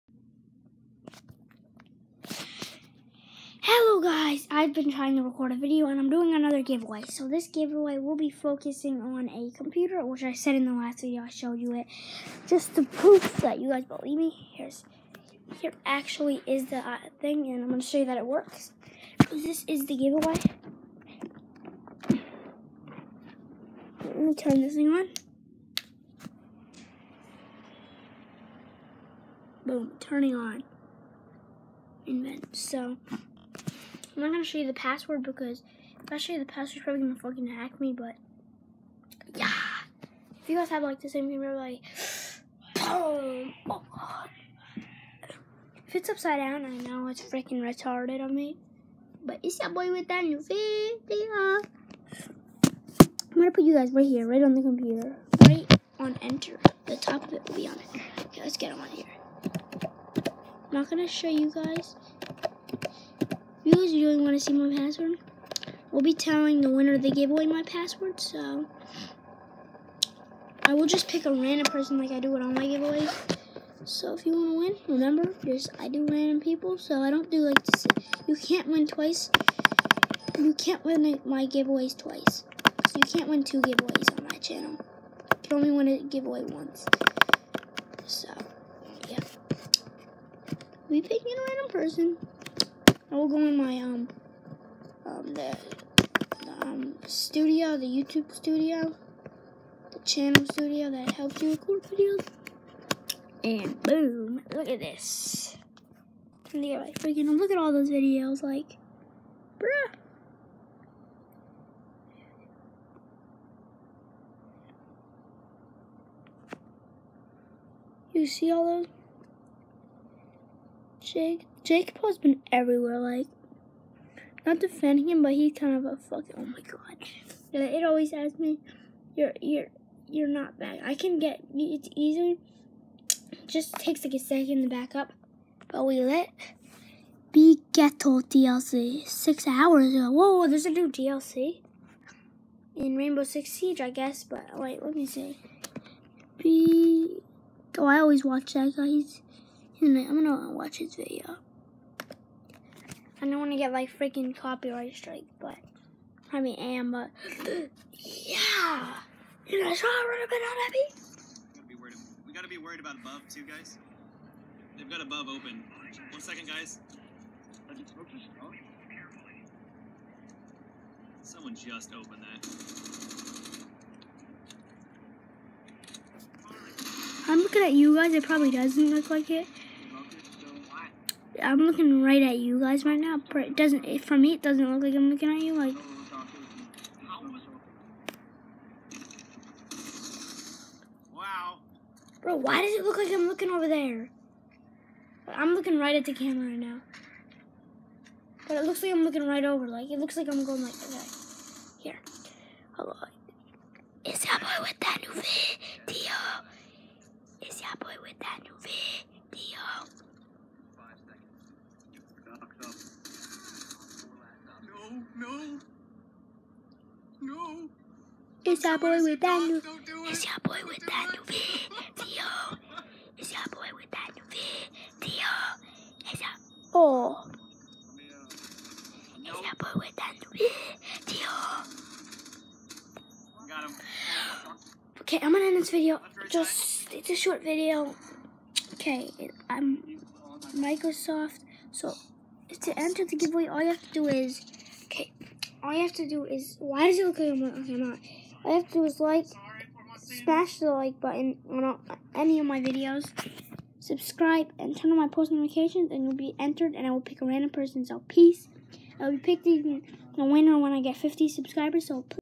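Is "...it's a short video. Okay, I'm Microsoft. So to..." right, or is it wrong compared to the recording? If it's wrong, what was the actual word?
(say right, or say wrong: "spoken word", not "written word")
right.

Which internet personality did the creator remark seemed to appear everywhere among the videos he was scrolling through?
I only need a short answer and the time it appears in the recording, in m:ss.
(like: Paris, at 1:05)
Jake Paul, at 2:01.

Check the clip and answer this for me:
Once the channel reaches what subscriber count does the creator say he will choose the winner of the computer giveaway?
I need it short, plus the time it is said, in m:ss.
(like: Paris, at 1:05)
50, at 4:20.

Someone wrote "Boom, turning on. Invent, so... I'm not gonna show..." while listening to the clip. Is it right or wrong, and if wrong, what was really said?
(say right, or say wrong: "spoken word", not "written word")
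right.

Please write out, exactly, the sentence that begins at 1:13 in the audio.
So if you want to win, remember, just I do random people, so I don't do like, this.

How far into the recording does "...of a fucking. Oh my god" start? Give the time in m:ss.
2:05.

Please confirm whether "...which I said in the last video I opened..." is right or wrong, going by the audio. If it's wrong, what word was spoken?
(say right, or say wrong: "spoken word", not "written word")
wrong: "showed", not "opened".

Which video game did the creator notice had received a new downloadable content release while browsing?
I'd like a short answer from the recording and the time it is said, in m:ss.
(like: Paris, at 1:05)
Rainbow Six Siege, at 2:22.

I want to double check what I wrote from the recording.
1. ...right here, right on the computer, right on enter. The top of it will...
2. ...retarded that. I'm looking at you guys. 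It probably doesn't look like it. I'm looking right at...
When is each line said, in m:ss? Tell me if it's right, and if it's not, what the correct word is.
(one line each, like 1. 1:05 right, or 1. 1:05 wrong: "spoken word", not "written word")
1. 0:53 right
2. 2:51 wrong: "opened", not "retarded".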